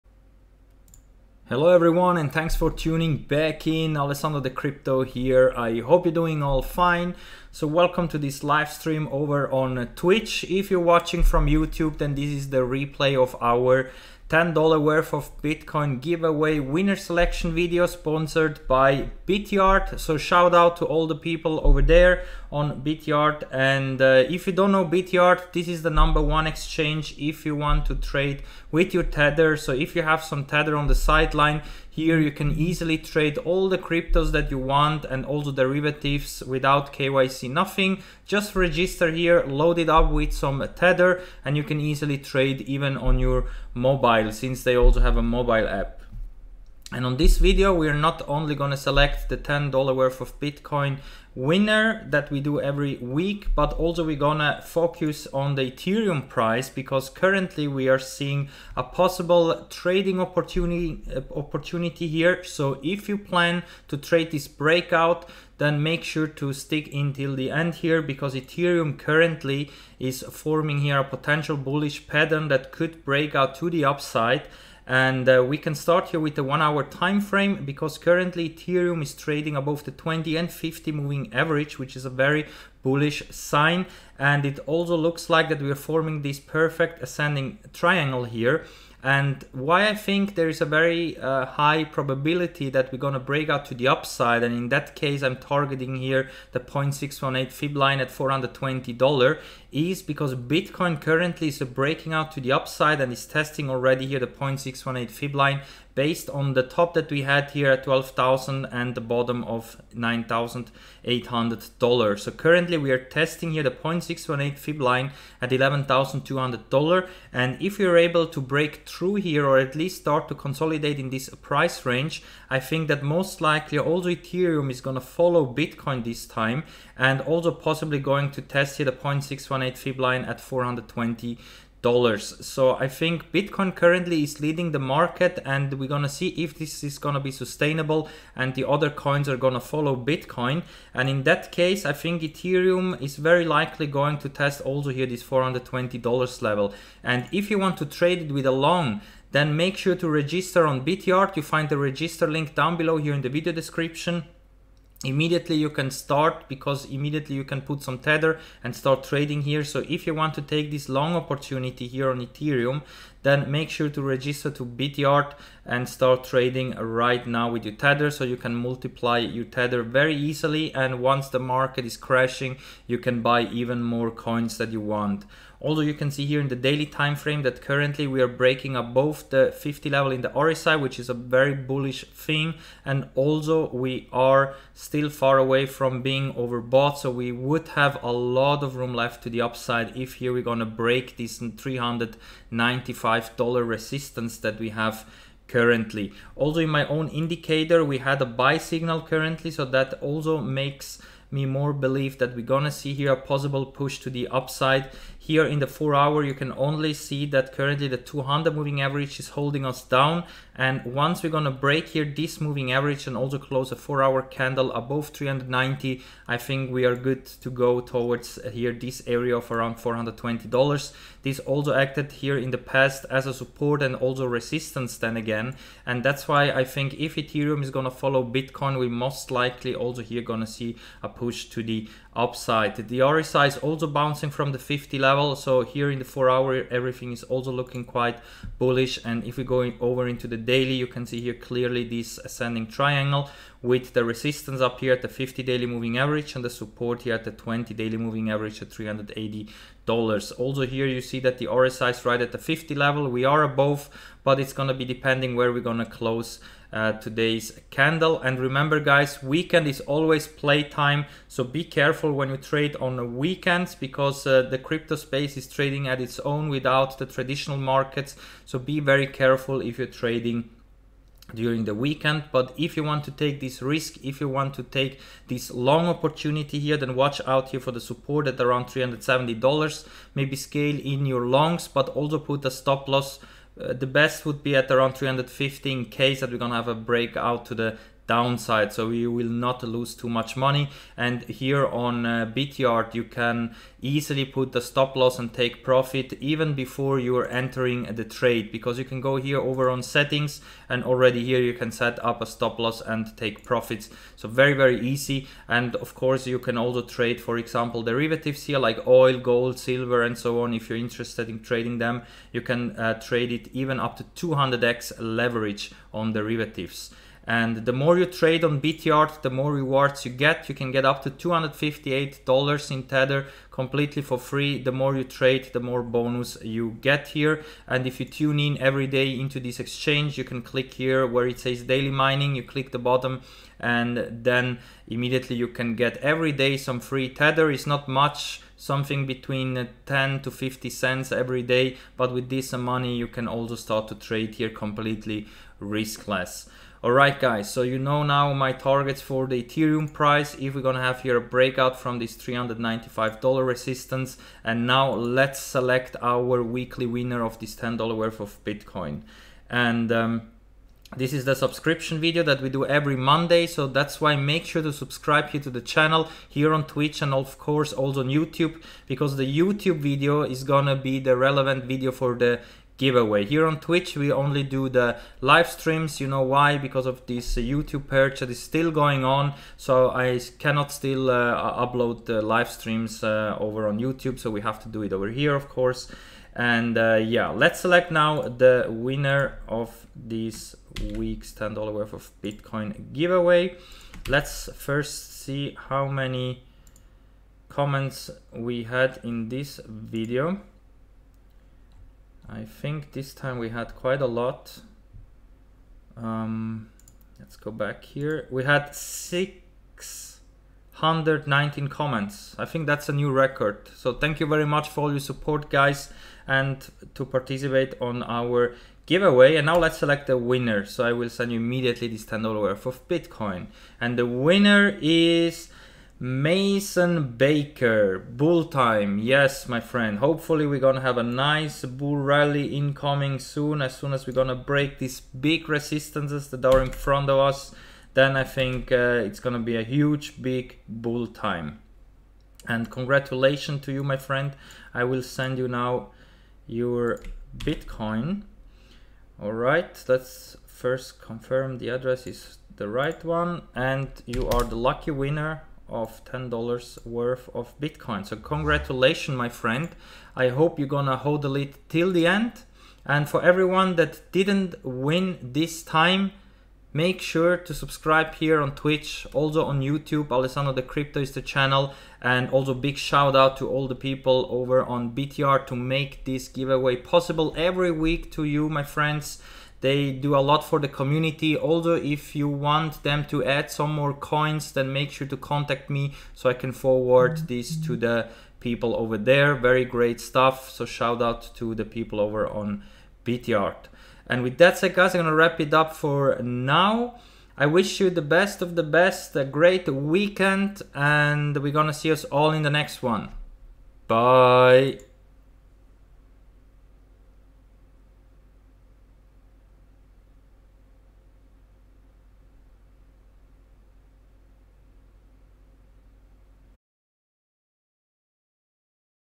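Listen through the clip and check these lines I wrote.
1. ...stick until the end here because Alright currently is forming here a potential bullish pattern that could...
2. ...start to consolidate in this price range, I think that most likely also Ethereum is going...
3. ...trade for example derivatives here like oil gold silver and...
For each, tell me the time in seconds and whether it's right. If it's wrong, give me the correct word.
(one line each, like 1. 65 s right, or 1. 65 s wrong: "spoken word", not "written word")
1. 66 s wrong: "Ethereum", not "Alright"
2. 120 s right
3. 306 s right.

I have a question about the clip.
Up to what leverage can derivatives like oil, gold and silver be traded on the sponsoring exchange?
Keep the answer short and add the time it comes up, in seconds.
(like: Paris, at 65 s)
200x, at 314 s.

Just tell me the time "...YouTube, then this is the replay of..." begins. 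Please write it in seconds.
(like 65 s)
11 s.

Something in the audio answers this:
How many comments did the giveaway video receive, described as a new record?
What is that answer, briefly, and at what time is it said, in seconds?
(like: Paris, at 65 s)
619, at 408 s.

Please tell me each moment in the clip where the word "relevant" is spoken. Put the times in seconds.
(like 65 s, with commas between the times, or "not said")
371 s.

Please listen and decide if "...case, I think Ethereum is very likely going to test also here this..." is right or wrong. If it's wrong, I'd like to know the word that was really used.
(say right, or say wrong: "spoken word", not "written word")
right.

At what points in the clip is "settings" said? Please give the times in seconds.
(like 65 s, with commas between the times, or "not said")
299 s.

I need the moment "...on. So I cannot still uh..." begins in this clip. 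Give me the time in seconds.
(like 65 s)
379 s.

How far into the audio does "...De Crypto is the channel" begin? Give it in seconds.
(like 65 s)
470 s.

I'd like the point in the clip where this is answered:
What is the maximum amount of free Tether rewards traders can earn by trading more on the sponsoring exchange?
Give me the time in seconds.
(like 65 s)
321 s.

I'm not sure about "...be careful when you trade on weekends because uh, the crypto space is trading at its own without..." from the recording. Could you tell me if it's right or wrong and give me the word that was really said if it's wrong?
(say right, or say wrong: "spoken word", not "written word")
right.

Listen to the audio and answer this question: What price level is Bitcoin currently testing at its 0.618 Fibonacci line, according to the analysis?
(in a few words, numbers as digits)
$11,200.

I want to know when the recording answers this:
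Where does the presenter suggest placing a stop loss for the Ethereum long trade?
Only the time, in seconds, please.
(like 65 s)
284 s.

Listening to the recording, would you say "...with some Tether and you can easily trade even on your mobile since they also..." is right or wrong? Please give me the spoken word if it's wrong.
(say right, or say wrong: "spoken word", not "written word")
right.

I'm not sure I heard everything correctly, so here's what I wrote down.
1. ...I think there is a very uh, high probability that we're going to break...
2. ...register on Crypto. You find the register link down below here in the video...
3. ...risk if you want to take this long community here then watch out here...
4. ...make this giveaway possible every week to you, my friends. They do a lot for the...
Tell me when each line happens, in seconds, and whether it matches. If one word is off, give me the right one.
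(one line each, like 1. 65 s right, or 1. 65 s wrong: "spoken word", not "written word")
1. 89 s right
2. 150 s wrong: "BitYard", not "Crypto"
3. 273 s wrong: "opportunity", not "community"
4. 475 s right.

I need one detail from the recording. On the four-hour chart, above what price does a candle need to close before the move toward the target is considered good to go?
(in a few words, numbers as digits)
390.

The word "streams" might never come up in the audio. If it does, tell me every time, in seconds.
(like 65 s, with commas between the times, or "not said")
8 s, 375 s, 382 s.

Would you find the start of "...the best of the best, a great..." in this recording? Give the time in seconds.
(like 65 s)
497 s.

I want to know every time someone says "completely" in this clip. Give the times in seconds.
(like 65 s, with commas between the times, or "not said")
323 s, 344 s.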